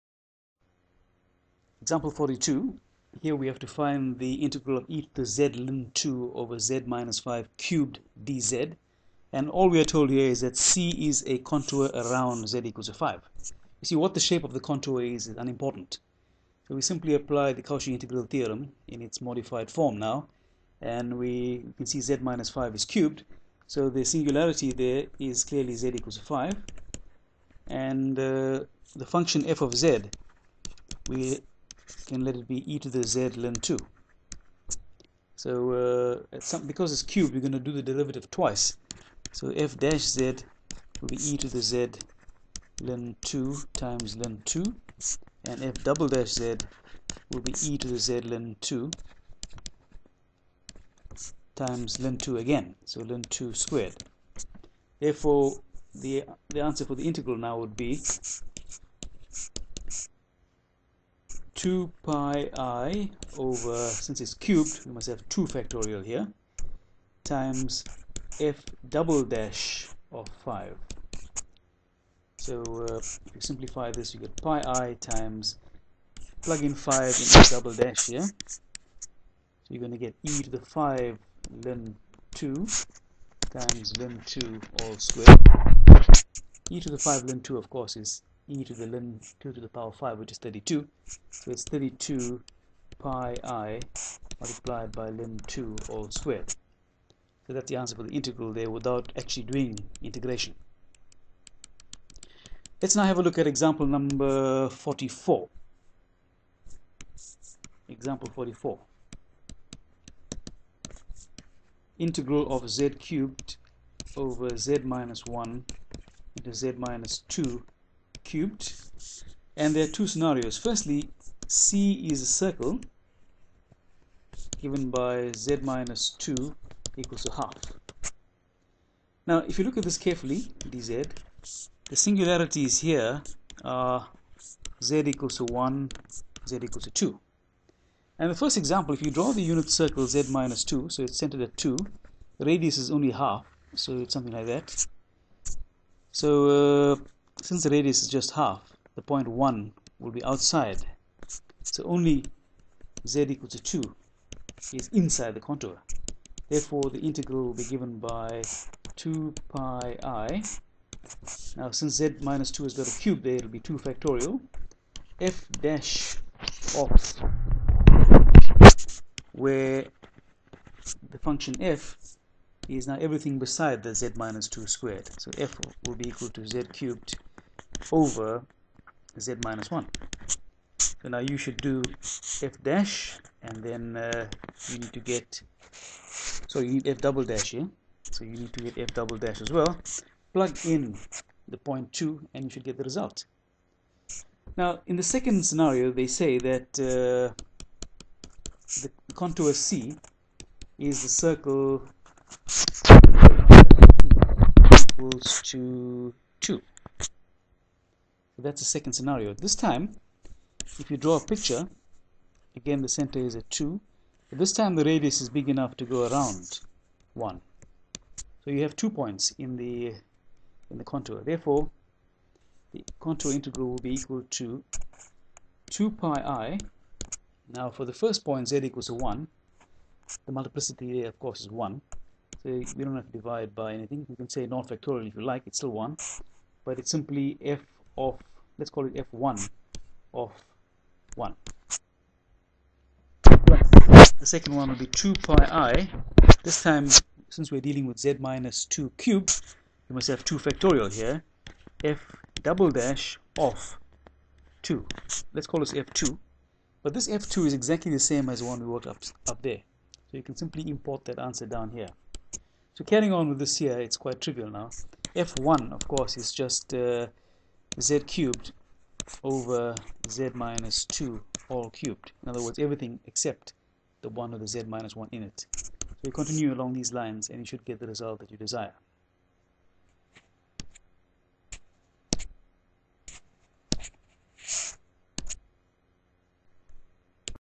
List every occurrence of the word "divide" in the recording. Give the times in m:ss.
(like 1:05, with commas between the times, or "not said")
3:53.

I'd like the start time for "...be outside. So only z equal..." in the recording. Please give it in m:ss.
2:30.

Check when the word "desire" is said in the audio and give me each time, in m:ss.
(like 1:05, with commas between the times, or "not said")
4:38.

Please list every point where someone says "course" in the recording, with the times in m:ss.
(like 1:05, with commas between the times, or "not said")
1:27, 3:51, 4:25.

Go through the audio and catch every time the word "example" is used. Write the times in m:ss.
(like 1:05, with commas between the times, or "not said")
0:01, 1:43, 1:47, 2:18.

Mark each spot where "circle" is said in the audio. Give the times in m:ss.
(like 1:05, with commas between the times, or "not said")
2:02, 2:19, 3:21.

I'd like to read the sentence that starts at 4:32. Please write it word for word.
In other words, everything except the 1 with the z minus 1 in it.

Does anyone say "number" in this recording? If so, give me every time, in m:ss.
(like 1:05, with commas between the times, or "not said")
1:43.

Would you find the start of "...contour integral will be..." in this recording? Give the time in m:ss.
3:42.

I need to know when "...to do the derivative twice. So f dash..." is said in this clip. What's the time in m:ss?
0:37.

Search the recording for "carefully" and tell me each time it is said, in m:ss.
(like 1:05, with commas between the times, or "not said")
2:09.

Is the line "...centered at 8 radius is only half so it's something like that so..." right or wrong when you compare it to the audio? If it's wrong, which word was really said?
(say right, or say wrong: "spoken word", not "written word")
wrong: "2", not "8".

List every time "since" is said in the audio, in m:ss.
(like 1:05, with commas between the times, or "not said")
1:03, 2:27, 2:41, 4:07.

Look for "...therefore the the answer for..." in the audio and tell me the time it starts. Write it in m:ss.
0:54.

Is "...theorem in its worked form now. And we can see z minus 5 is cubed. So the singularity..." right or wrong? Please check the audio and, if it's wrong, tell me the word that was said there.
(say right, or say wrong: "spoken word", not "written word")
wrong: "modified", not "worked".